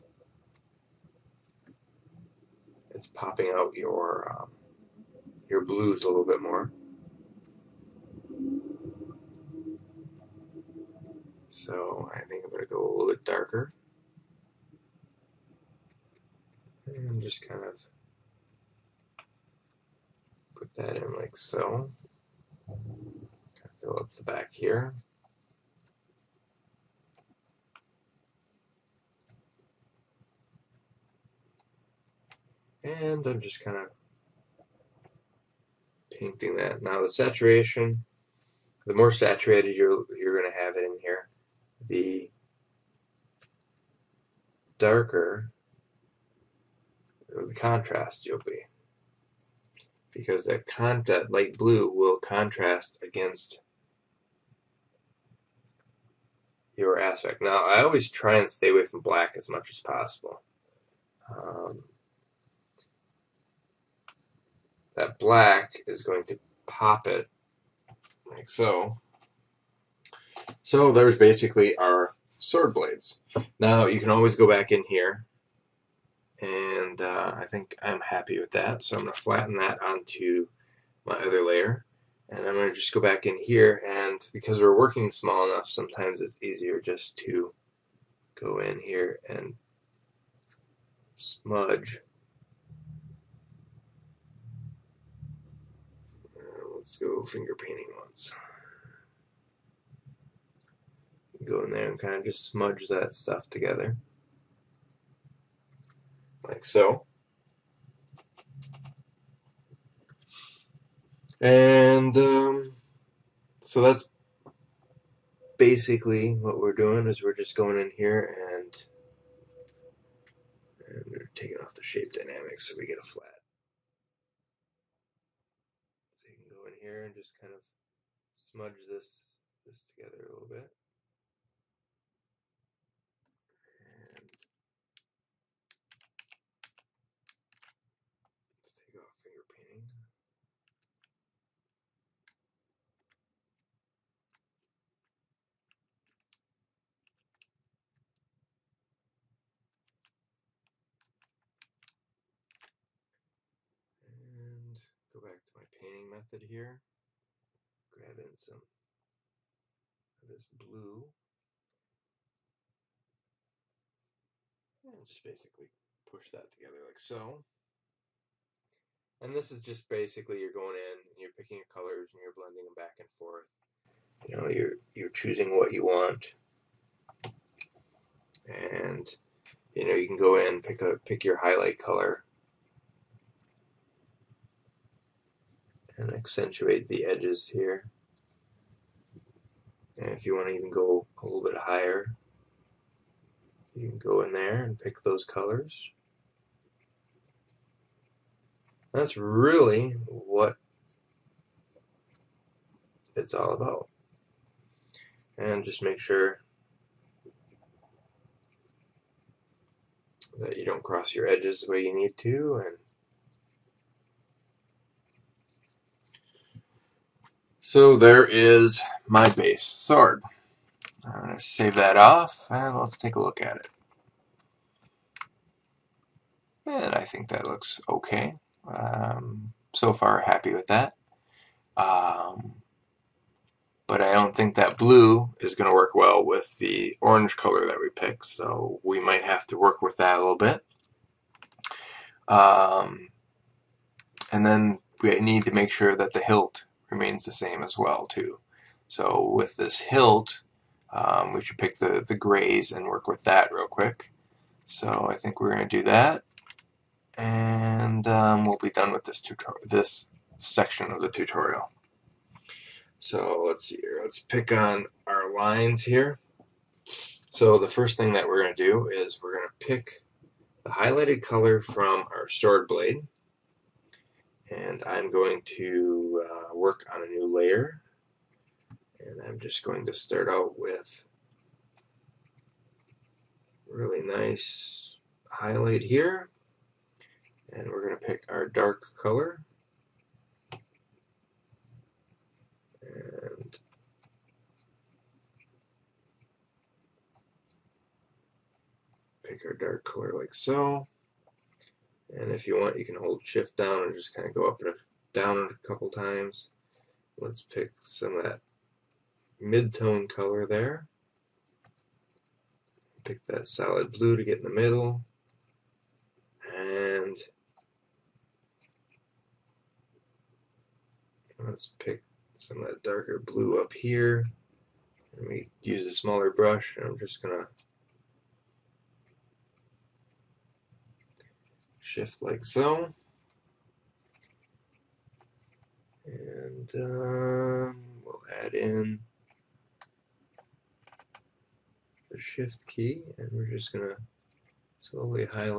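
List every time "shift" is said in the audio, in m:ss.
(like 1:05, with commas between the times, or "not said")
5:03, 5:31, 5:42.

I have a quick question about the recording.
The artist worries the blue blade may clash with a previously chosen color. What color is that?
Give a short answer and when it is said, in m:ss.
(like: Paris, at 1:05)
Orange, at 3:56.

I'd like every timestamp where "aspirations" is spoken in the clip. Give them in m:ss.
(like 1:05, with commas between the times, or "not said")
not said.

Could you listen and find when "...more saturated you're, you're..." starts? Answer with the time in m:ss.
0:38.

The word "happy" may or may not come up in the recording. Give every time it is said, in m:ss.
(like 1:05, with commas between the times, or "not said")
1:18, 3:50.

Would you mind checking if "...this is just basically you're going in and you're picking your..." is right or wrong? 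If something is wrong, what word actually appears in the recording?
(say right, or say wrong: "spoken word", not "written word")
right.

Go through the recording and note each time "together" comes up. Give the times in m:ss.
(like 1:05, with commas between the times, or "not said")
1:43, 2:09, 2:46.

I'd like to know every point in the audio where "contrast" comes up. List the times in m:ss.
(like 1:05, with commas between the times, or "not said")
0:47, 0:52.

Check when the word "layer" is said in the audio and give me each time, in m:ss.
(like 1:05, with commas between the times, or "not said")
1:21, 4:37.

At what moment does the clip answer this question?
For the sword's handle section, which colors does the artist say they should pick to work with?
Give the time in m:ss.
4:12.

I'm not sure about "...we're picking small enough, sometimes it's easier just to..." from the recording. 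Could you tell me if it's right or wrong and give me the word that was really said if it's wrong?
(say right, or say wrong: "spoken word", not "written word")
wrong: "working", not "picking".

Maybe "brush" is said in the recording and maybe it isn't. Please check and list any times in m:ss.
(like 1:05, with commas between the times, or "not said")
5:26.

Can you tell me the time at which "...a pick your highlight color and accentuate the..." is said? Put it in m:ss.
3:00.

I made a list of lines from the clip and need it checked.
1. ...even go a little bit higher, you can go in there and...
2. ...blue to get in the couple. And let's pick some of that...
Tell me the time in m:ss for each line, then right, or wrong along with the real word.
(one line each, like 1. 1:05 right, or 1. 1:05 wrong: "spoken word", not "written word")
1. 3:10 right
2. 5:13 wrong: "middle", not "couple".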